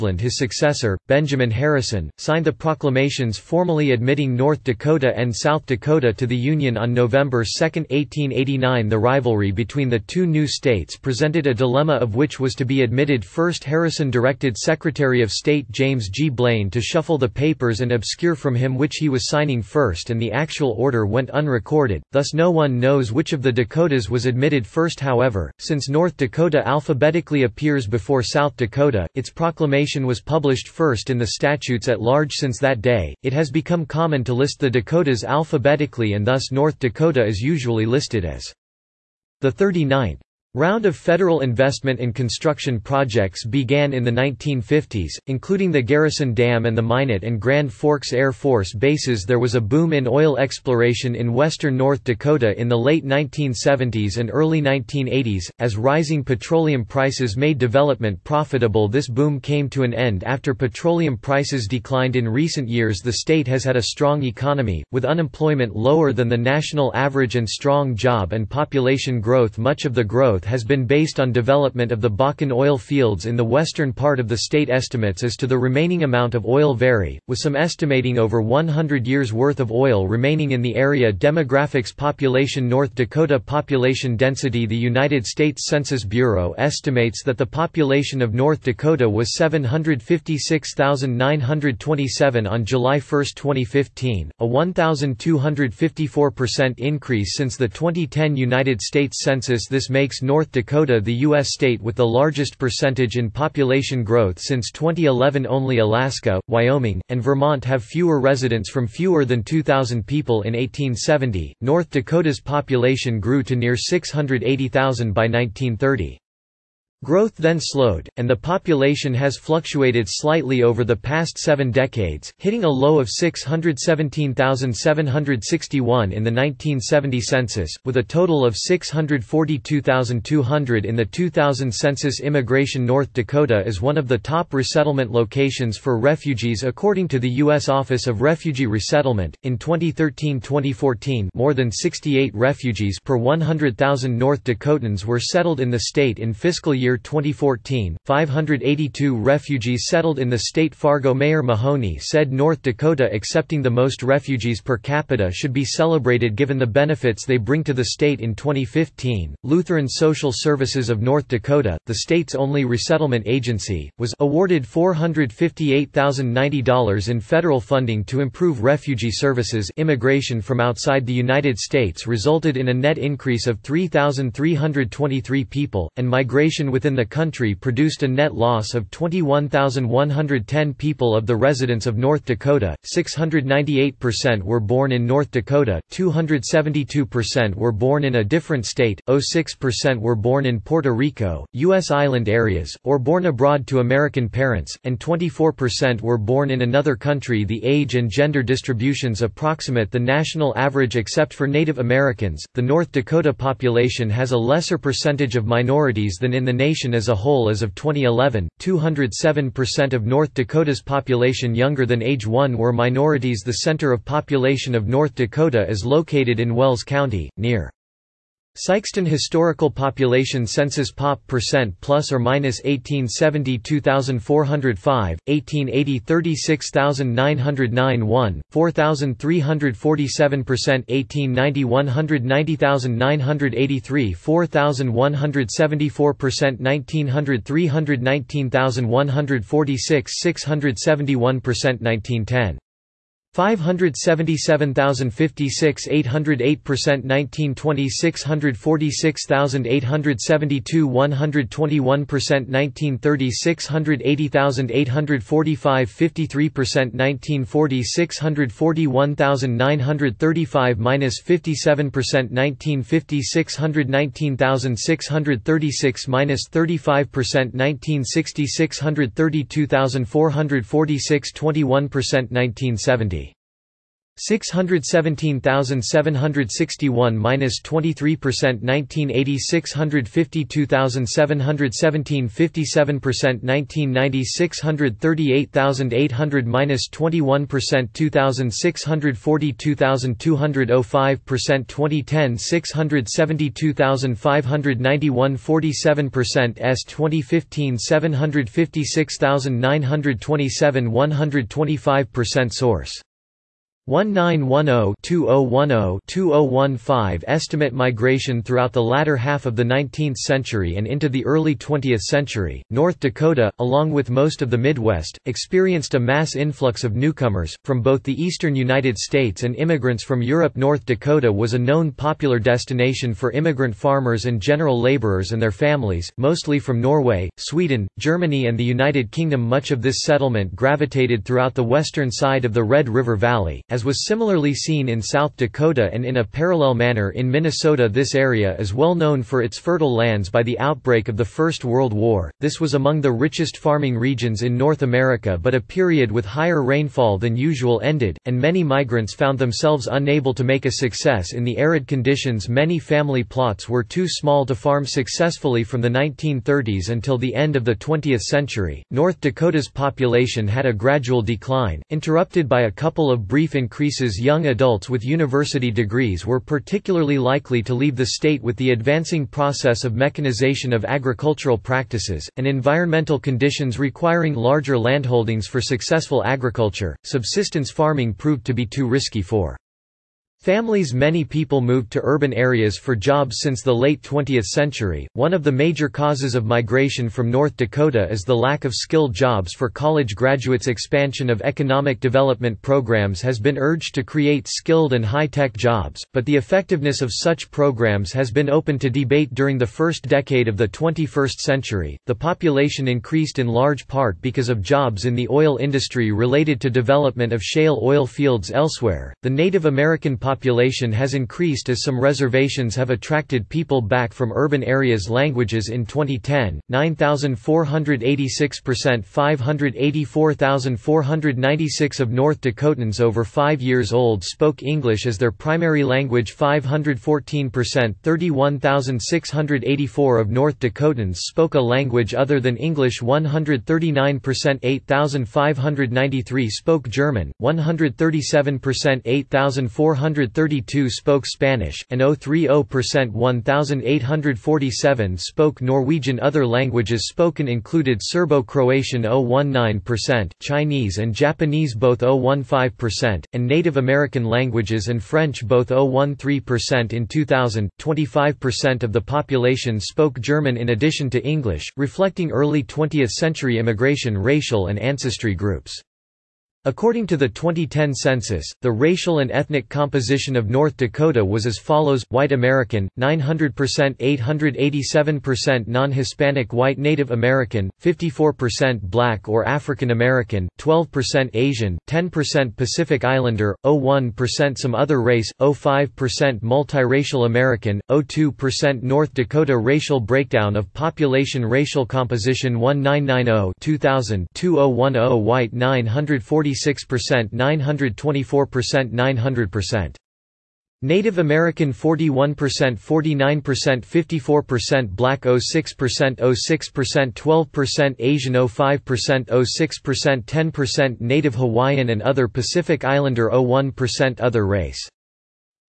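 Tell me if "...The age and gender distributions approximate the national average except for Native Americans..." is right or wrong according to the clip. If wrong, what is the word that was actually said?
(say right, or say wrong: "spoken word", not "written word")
right.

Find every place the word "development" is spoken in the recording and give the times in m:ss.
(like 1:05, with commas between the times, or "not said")
0:57, 1:11, 6:31, 6:46.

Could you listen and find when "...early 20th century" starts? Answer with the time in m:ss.
5:11.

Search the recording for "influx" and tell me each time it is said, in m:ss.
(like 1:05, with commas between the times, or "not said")
5:16.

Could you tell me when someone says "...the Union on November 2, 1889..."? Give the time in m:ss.
0:06.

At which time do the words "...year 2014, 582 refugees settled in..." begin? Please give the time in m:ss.
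2:26.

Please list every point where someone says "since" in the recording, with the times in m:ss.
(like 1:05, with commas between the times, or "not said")
0:25, 0:32, 1:37, 1:44, 6:23.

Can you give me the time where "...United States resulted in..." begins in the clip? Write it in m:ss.
2:51.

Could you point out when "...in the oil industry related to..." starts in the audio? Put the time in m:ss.
6:45.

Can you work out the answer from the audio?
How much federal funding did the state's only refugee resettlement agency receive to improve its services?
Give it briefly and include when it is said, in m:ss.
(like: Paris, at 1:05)
$458,090, at 2:44.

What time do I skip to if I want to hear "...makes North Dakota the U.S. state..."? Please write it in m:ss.
1:39.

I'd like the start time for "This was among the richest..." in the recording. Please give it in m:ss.
5:42.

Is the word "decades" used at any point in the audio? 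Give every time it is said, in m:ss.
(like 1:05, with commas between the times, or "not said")
2:01, 6:40.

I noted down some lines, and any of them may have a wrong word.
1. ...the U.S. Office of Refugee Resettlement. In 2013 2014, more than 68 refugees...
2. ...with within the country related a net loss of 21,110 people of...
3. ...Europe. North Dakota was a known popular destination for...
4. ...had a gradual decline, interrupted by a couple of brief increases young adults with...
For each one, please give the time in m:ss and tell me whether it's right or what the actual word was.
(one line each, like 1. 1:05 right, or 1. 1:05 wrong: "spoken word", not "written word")
1. 2:17 right
2. 2:56 wrong: "produced", not "related"
3. 5:20 right
4. 6:00 right.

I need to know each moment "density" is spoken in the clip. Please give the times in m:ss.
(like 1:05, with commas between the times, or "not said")
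1:24.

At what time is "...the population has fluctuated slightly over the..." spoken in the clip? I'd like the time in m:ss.
1:58.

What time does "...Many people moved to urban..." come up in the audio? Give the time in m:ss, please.
6:20.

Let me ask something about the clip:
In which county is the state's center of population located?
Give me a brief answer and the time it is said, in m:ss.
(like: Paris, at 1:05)
Wells County, at 3:36.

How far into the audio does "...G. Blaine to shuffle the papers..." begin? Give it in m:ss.
0:16.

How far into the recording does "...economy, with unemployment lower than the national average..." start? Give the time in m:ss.
1:04.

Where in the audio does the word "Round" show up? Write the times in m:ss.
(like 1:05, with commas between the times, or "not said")
0:40.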